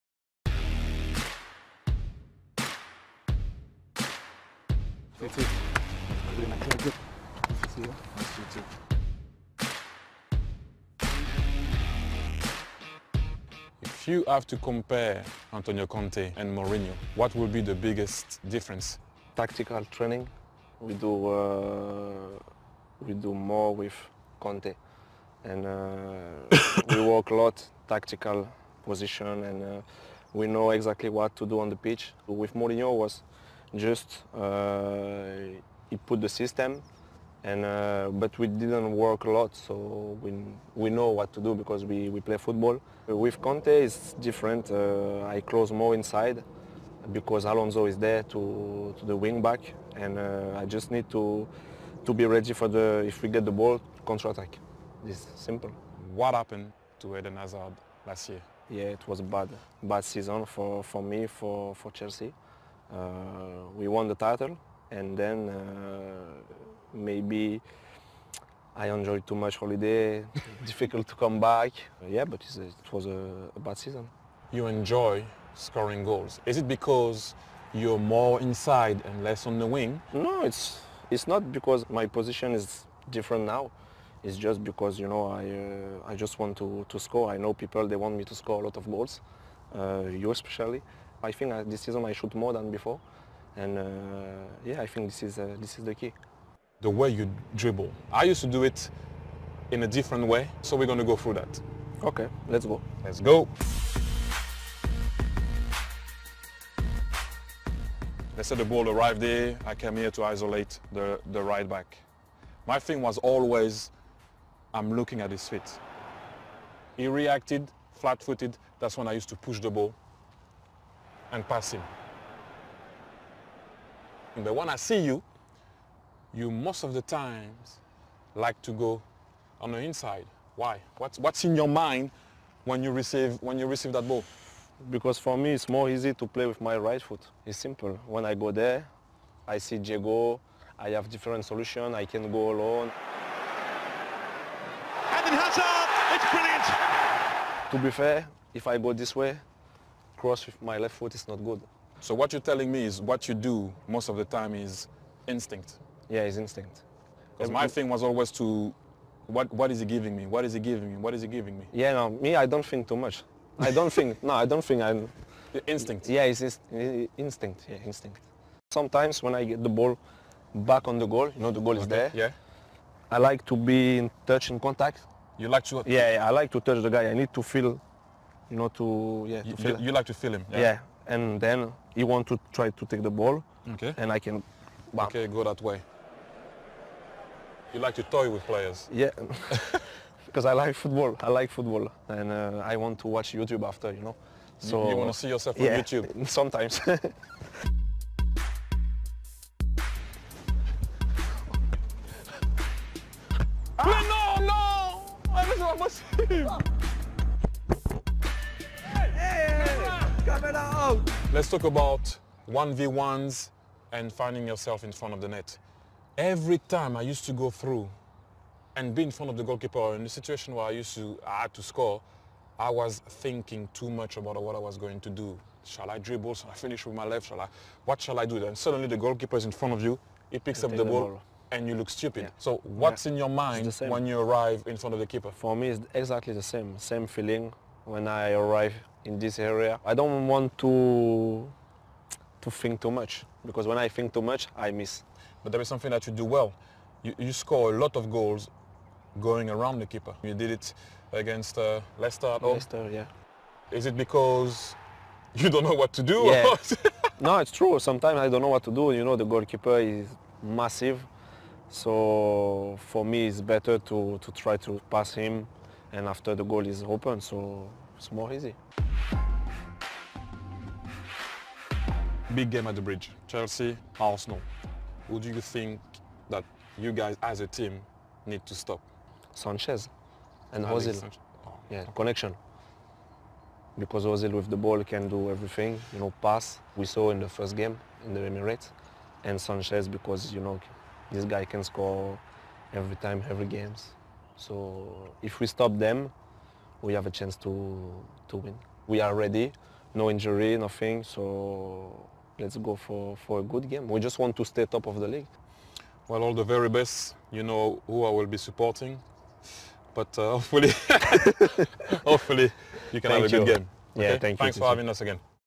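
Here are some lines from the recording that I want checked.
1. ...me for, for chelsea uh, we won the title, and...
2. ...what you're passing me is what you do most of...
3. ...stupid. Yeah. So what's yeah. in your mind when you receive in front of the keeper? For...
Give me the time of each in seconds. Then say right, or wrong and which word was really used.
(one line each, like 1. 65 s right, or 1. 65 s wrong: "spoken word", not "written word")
1. 61 s right
2. 152 s wrong: "telling", not "passing"
3. 231 s wrong: "arrive", not "receive".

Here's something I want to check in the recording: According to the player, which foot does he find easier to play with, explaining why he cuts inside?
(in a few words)
Right foot.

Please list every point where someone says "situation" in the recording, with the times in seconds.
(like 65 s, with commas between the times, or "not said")
220 s.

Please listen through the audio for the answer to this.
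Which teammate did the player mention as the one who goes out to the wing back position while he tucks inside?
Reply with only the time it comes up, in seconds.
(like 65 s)
47 s.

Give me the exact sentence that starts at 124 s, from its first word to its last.
But when I see you, you most of the times like to go on the inside.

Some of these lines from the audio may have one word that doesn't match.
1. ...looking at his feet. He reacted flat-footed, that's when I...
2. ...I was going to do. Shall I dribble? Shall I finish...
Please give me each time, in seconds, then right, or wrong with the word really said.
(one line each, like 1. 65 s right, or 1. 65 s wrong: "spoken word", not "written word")
1. 114 s right
2. 224 s right.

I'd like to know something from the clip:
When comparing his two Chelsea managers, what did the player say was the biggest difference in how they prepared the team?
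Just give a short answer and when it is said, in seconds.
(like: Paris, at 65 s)
Tactical training, at 19 s.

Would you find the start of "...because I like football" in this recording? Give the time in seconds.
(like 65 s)
190 s.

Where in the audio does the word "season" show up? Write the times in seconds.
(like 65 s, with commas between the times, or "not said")
60 s, 73 s, 91 s.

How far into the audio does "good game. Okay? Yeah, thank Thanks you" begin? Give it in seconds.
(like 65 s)
313 s.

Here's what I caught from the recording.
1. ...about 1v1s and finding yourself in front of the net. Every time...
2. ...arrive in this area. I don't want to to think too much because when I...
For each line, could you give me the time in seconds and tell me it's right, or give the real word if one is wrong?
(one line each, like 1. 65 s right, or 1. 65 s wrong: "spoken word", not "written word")
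1. 211 s right
2. 238 s right.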